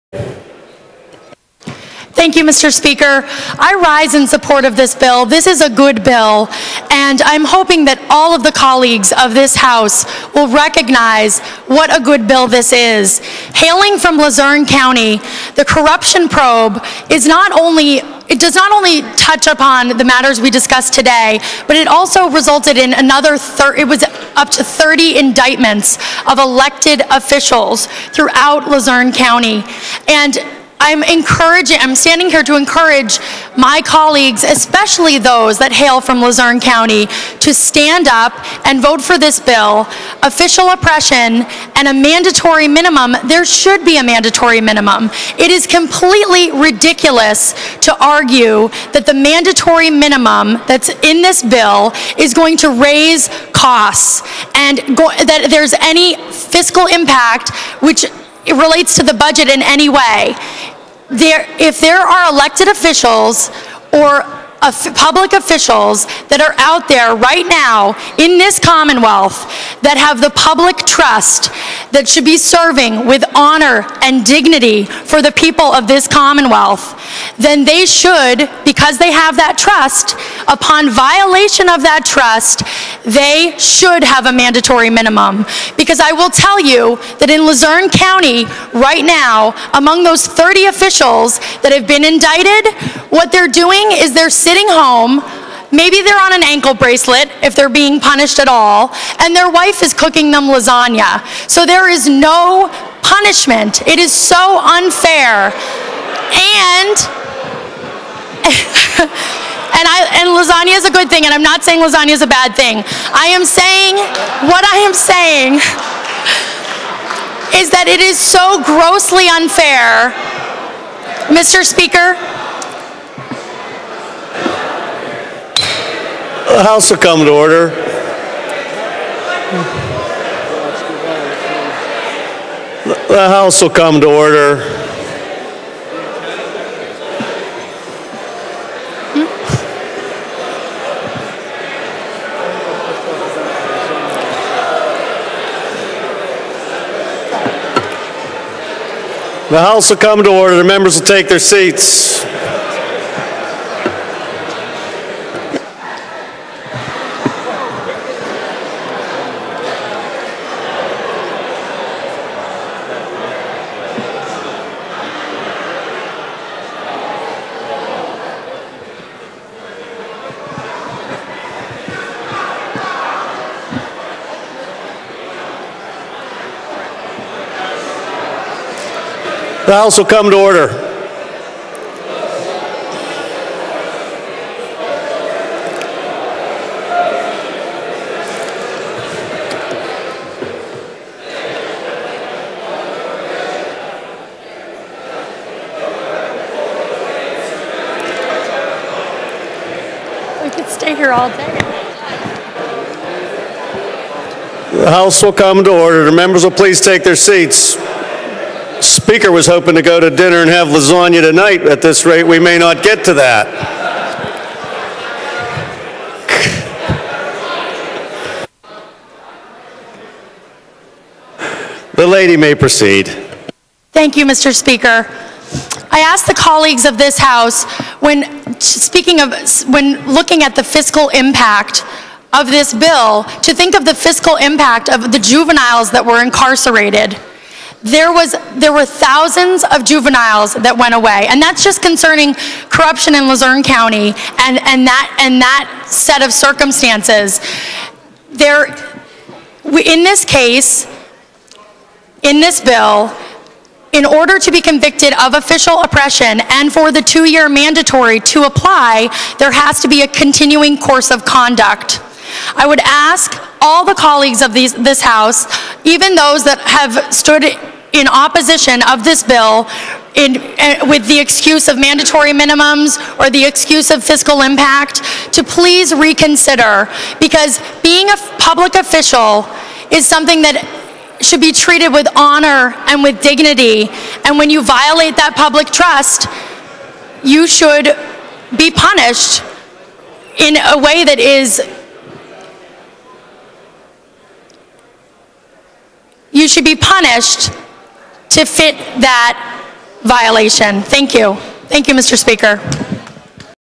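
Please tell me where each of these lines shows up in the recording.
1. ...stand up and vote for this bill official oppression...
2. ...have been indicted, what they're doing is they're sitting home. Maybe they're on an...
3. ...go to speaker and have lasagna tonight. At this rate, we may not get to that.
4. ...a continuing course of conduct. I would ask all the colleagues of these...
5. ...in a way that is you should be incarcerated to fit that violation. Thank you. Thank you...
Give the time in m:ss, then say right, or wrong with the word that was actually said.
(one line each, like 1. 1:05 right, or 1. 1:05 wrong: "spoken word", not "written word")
1. 0:37 right
2. 1:31 right
3. 3:29 wrong: "dinner", not "speaker"
4. 4:20 right
5. 4:50 wrong: "punished", not "incarcerated".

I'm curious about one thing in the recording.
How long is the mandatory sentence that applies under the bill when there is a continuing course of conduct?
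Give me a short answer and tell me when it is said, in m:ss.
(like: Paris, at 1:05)
2 years, at 4:17.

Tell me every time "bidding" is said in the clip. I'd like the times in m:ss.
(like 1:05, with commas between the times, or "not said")
not said.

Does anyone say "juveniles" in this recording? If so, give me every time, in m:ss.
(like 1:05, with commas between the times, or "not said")
3:55, 3:59.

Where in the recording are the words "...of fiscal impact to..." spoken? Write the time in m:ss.
4:33.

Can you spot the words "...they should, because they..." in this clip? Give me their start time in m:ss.
1:17.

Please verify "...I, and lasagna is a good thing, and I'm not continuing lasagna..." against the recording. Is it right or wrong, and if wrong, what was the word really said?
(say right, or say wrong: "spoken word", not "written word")
wrong: "saying", not "continuing".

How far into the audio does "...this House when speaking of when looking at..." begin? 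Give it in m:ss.
3:46.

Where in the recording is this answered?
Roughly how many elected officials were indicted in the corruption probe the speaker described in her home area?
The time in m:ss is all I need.
0:24.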